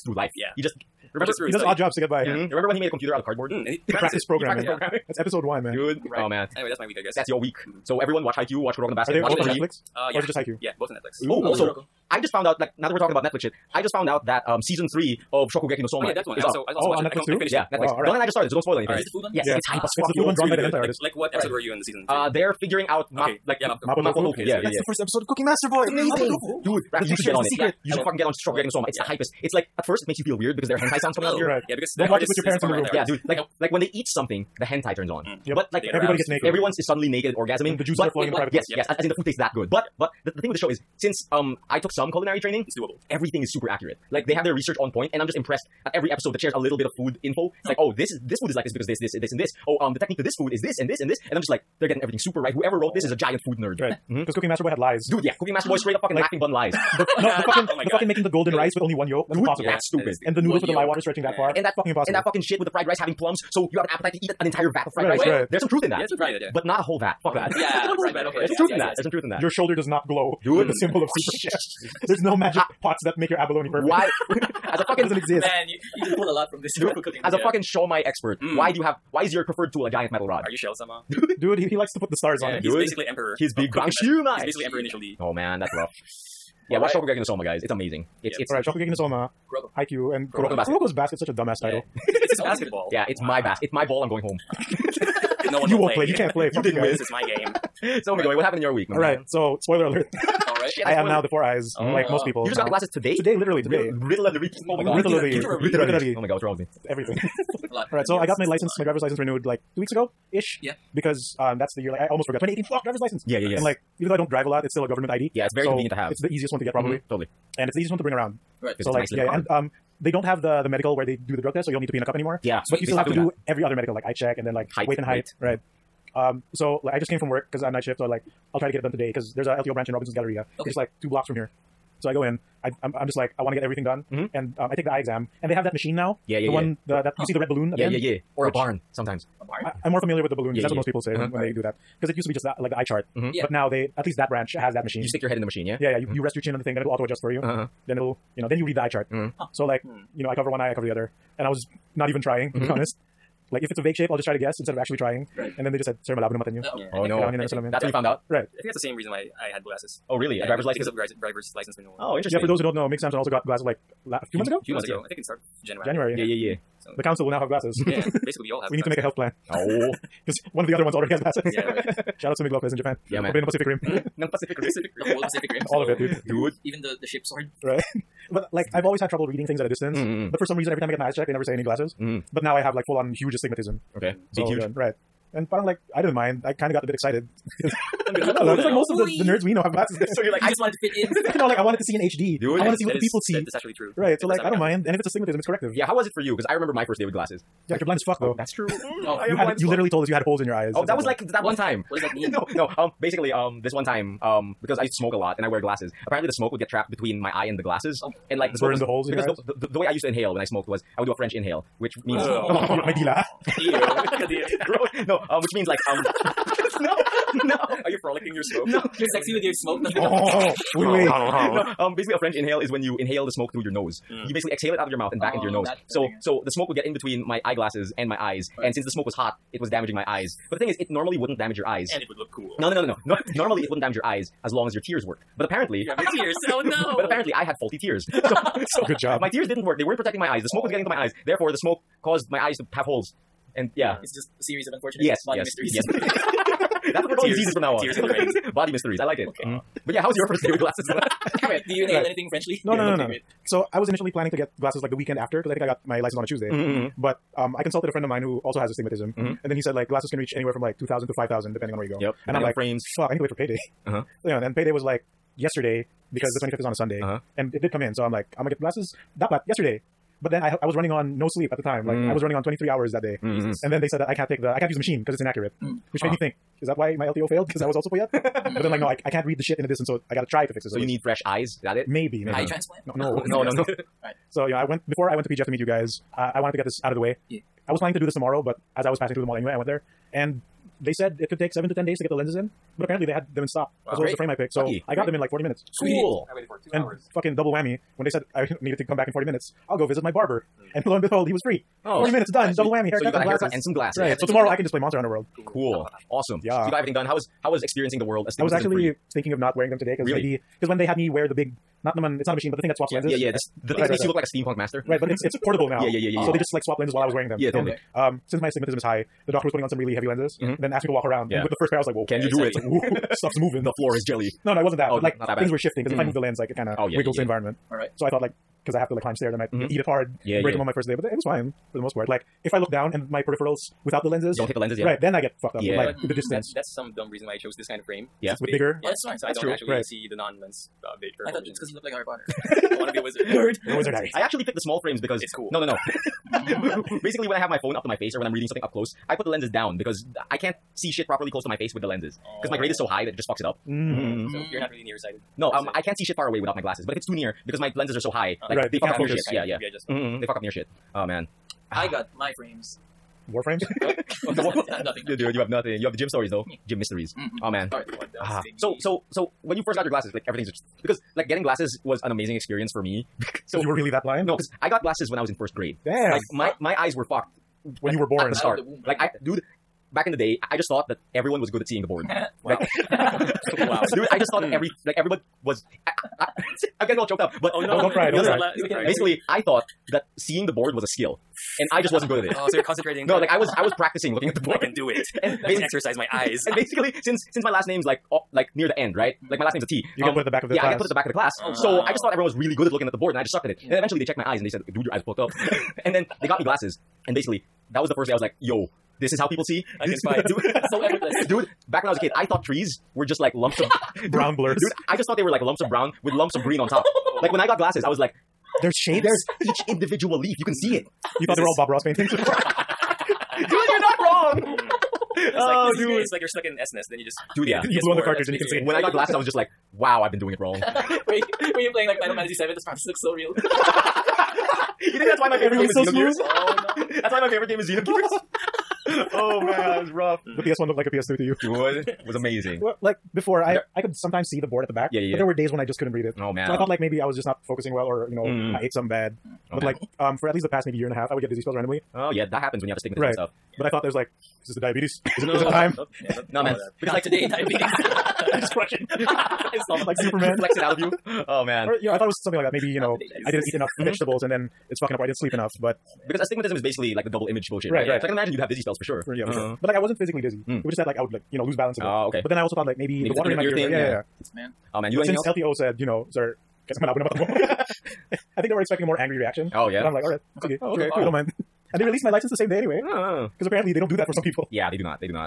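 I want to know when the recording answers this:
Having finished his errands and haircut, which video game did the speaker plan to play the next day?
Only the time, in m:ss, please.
5:04.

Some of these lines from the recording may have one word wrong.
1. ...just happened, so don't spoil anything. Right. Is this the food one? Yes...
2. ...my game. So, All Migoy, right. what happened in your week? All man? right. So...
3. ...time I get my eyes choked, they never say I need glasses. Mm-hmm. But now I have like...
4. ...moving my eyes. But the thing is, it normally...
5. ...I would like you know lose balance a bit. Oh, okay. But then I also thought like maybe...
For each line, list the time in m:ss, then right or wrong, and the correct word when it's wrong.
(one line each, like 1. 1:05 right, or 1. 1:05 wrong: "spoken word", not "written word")
1. 0:18 wrong: "started", not "happened"
2. 1:37 right
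3. 3:00 wrong: "checked", not "choked"
4. 3:49 wrong: "damaging", not "moving"
5. 7:50 right.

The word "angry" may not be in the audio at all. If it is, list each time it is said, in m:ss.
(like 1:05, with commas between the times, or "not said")
7:58.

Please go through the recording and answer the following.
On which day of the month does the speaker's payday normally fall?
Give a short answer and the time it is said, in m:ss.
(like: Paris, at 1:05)
25th, at 4:26.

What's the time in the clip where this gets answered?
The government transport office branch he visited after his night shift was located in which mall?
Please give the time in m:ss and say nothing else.
2:09.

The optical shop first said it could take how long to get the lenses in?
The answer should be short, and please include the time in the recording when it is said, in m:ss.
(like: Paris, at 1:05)
7 to 10 days, at 4:51.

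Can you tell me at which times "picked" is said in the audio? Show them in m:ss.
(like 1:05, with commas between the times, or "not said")
4:54, 5:44.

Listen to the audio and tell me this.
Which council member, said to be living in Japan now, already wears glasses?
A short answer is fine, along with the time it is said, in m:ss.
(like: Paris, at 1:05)
Mig Lopez, at 2:52.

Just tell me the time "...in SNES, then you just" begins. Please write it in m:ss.
7:06.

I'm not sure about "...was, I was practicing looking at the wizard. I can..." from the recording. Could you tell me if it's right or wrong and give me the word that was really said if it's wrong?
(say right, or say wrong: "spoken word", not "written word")
wrong: "board", not "wizard".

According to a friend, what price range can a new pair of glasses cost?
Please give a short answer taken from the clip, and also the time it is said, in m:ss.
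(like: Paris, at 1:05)
2,000 to 5,000, at 4:20.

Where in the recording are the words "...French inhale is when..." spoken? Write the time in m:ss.
3:42.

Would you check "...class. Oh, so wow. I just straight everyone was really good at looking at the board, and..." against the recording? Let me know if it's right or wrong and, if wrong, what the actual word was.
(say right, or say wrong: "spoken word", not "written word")
wrong: "thought", not "straight".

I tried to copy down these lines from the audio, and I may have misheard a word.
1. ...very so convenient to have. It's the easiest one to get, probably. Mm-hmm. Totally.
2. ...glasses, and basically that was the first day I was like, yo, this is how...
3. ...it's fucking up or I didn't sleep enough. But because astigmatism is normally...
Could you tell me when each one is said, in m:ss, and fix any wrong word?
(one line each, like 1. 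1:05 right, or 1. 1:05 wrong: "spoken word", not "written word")
1. 1:55 right
2. 6:46 right
3. 7:44 wrong: "basically", not "normally".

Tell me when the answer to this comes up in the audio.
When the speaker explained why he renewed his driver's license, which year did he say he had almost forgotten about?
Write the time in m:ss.
1:52.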